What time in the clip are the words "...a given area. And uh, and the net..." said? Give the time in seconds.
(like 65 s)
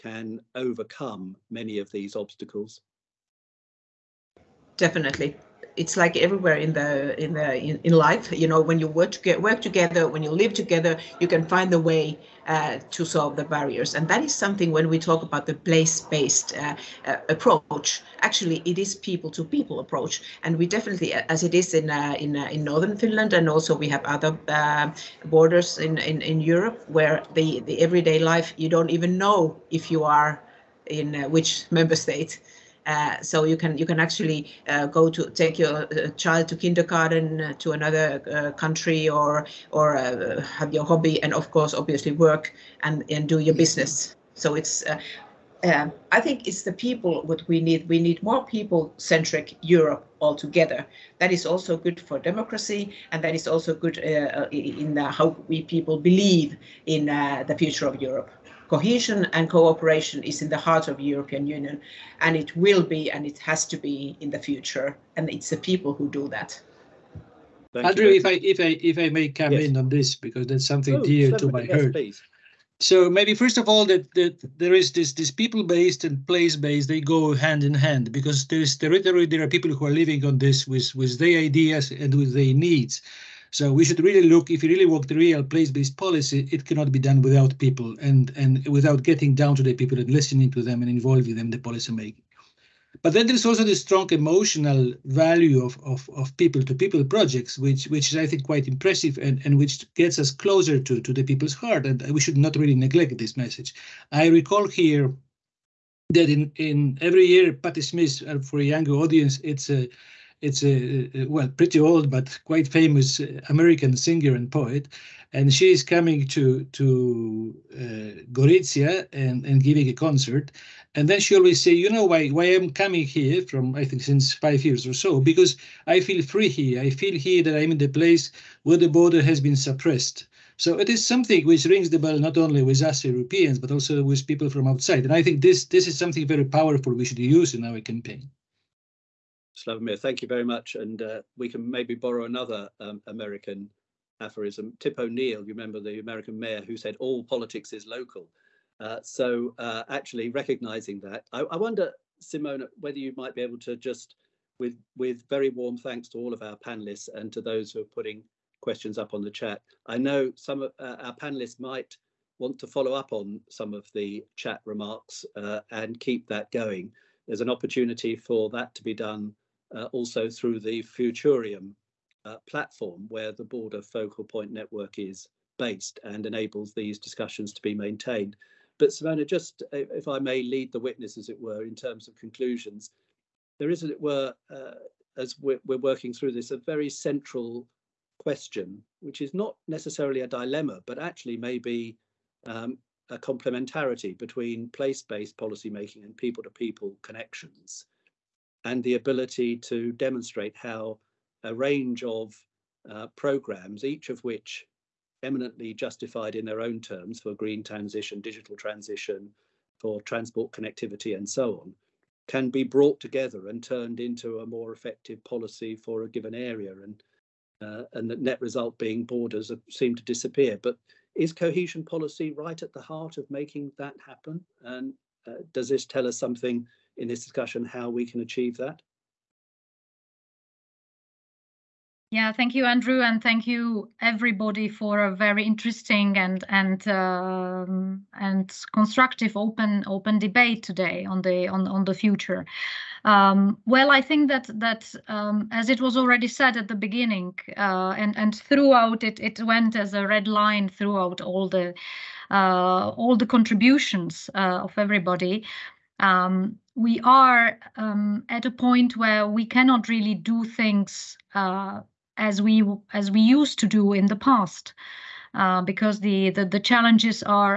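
216 s.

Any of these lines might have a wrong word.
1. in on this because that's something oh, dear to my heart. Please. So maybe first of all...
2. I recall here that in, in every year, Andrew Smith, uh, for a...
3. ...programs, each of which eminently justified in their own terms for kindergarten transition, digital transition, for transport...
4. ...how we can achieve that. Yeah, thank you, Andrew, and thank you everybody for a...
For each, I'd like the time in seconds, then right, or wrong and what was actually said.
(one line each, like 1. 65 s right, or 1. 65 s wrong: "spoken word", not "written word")
1. 69 s right
2. 104 s wrong: "Patti", not "Andrew"
3. 203 s wrong: "green", not "kindergarten"
4. 227 s right.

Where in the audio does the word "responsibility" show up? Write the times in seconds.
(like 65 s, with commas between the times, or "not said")
not said.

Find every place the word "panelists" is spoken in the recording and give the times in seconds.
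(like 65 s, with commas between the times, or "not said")
156 s, 161 s.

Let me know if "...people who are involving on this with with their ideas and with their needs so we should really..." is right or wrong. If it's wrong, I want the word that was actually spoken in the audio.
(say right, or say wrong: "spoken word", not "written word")
wrong: "living", not "involving".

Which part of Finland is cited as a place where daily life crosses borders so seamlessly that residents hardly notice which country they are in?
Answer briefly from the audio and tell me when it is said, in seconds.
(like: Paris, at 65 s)
Northern Finland, at 22 s.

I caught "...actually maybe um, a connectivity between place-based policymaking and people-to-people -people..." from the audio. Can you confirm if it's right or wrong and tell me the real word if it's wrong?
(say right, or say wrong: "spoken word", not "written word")
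wrong: "complementarity", not "connectivity".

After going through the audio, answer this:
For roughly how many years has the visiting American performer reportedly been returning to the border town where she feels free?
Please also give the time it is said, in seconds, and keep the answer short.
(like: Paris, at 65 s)
5, at 124 s.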